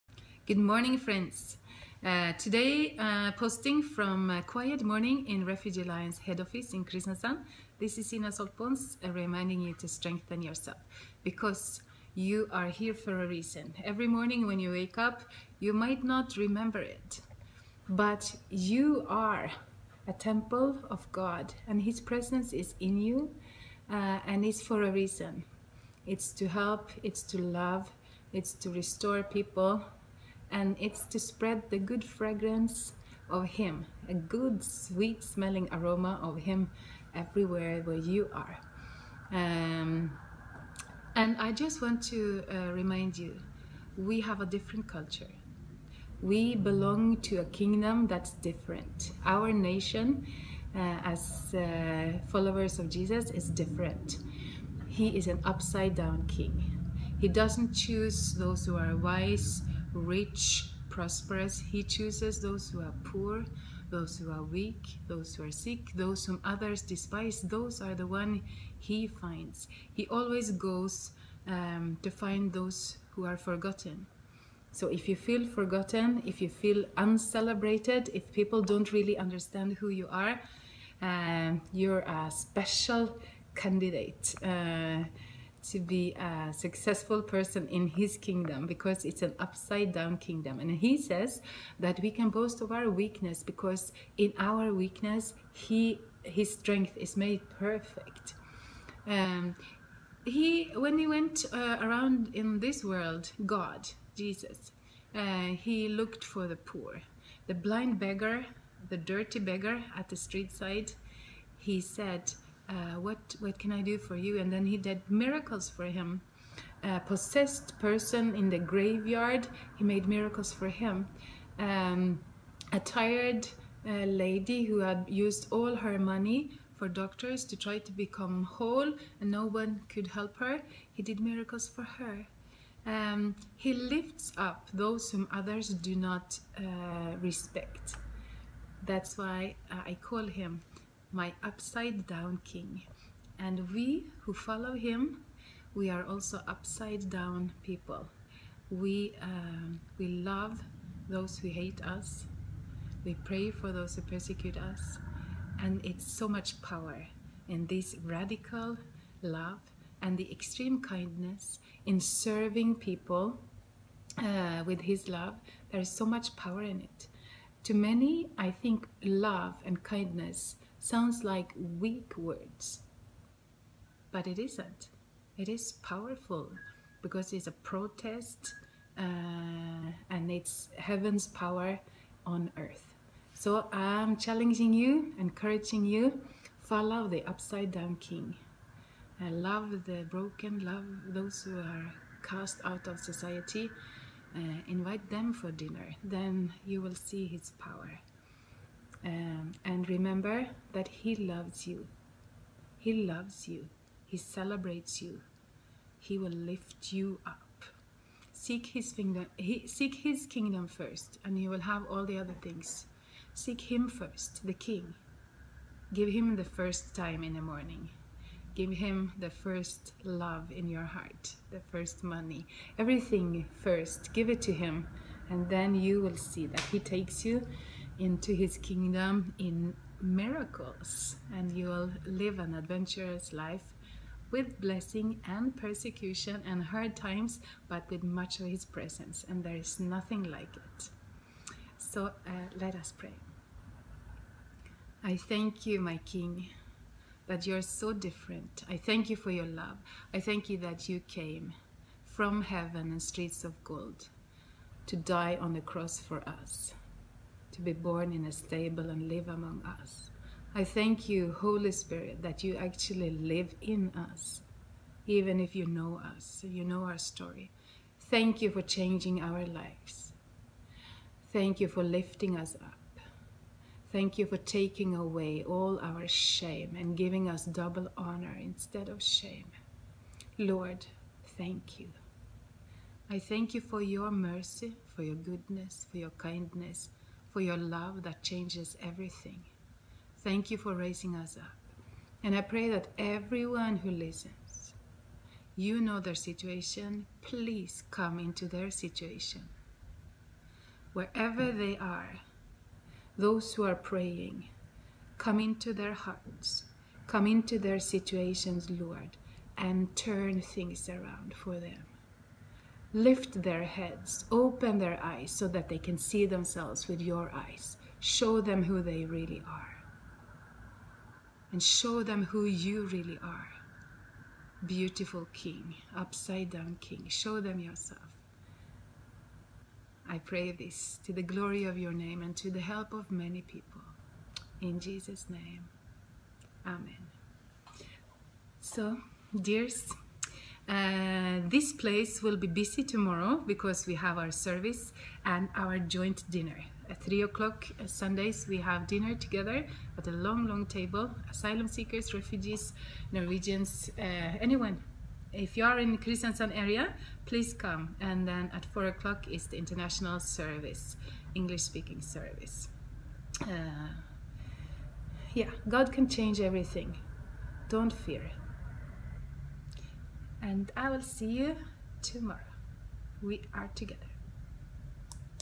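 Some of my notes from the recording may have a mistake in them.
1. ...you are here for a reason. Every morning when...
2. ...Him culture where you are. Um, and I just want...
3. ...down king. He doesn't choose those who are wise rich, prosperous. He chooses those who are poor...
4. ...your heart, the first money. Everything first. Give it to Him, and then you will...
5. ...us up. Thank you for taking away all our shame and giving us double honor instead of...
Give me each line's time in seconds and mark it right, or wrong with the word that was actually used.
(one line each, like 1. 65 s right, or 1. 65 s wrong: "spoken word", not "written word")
1. 12 s right
2. 36 s wrong: "everywhere", not "culture"
3. 55 s right
4. 220 s right
5. 272 s right.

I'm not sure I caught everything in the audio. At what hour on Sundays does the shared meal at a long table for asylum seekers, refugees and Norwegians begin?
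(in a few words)
3 o'clock.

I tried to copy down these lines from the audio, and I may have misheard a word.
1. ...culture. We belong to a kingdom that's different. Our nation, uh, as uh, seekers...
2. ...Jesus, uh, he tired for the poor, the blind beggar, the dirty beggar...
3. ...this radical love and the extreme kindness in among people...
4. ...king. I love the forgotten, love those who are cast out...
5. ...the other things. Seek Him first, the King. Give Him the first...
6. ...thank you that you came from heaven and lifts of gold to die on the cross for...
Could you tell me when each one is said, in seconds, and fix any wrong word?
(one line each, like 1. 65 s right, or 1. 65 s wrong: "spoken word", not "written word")
1. 44 s wrong: "followers", not "seekers"
2. 104 s wrong: "looked", not "tired"
3. 157 s wrong: "serving", not "among"
4. 187 s wrong: "broken", not "forgotten"
5. 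212 s right
6. 250 s wrong: "streets", not "lifts".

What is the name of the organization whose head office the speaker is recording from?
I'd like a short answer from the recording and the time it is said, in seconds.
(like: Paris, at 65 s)
Refugee Alliance, at 5 s.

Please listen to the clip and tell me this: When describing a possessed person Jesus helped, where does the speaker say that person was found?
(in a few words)
the graveyard.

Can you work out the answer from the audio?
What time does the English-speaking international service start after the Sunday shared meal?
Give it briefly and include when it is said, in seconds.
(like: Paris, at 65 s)
4 o'clock, at 358 s.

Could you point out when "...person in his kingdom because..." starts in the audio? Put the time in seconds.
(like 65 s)
87 s.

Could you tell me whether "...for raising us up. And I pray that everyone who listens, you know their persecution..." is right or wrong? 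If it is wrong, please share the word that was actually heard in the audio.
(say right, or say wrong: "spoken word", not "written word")
wrong: "situation", not "persecution".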